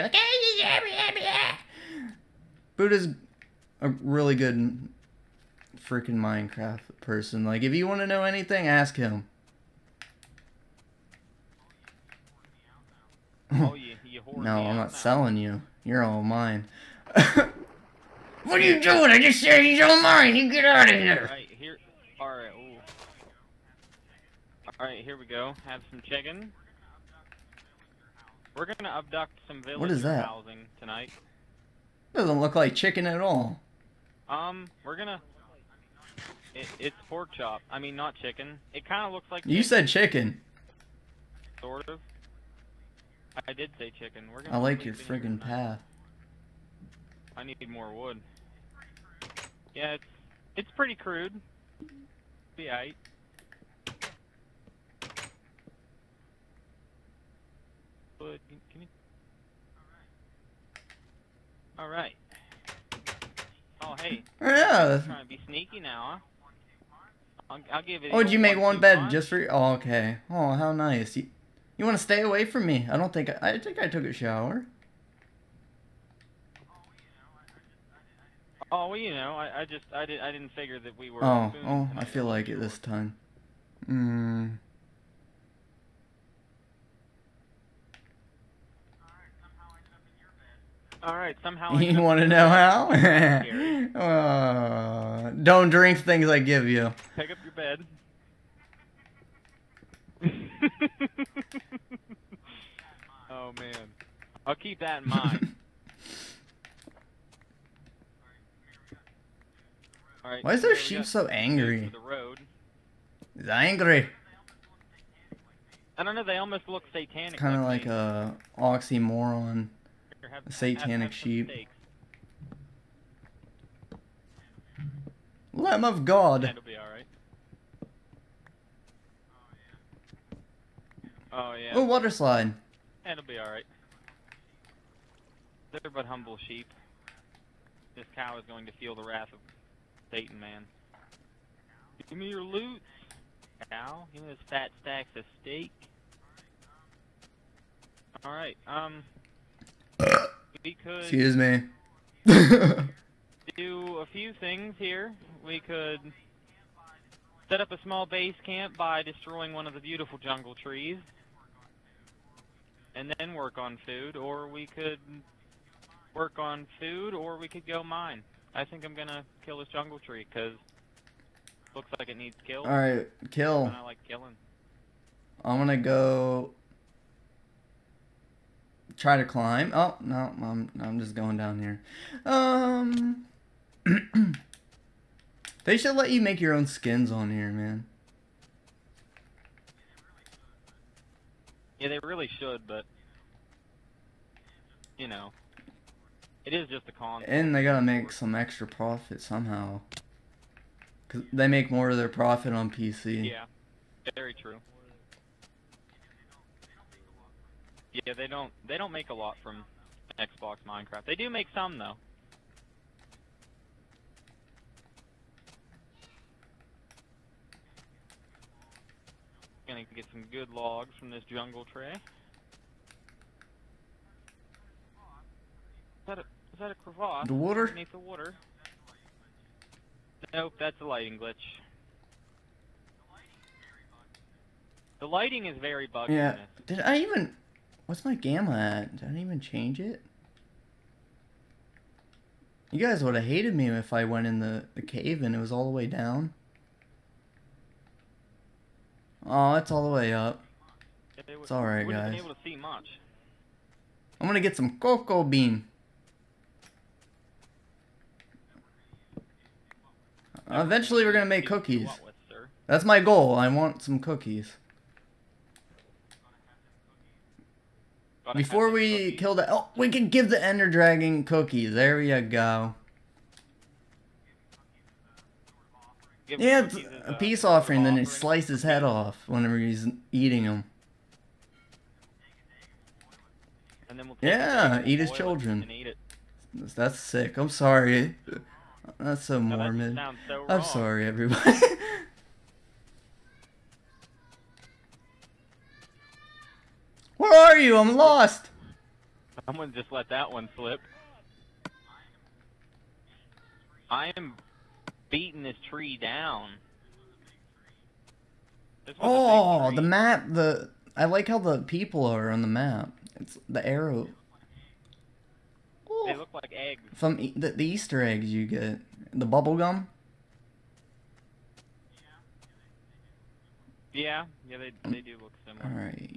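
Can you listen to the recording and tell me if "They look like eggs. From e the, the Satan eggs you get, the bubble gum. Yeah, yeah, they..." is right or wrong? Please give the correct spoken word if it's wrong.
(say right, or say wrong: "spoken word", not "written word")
wrong: "Easter", not "Satan".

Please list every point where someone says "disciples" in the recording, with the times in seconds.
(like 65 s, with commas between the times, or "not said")
not said.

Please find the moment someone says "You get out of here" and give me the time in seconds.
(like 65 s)
20 s.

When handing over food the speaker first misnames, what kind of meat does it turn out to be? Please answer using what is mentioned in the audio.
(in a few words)
Pork chop.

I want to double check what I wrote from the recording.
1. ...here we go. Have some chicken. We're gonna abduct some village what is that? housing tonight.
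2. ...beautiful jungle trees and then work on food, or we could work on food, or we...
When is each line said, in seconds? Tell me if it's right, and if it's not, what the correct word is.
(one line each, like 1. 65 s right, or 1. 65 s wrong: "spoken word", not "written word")
1. 25 s right
2. 159 s right.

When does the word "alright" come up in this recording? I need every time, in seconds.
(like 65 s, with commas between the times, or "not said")
133 s, 148 s.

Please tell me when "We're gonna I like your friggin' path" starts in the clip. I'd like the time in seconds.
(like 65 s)
44 s.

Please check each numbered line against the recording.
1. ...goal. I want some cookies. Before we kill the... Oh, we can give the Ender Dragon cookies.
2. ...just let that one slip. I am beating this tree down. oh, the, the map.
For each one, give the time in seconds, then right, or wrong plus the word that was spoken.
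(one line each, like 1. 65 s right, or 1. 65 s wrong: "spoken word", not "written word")
1. 262 s right
2. 299 s right.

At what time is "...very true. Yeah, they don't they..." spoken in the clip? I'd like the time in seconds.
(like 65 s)
204 s.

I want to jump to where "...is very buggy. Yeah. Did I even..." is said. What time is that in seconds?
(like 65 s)
235 s.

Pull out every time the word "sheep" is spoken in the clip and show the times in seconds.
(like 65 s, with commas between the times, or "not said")
110 s, 121 s, 136 s.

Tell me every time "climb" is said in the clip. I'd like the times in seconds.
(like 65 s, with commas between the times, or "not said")
179 s.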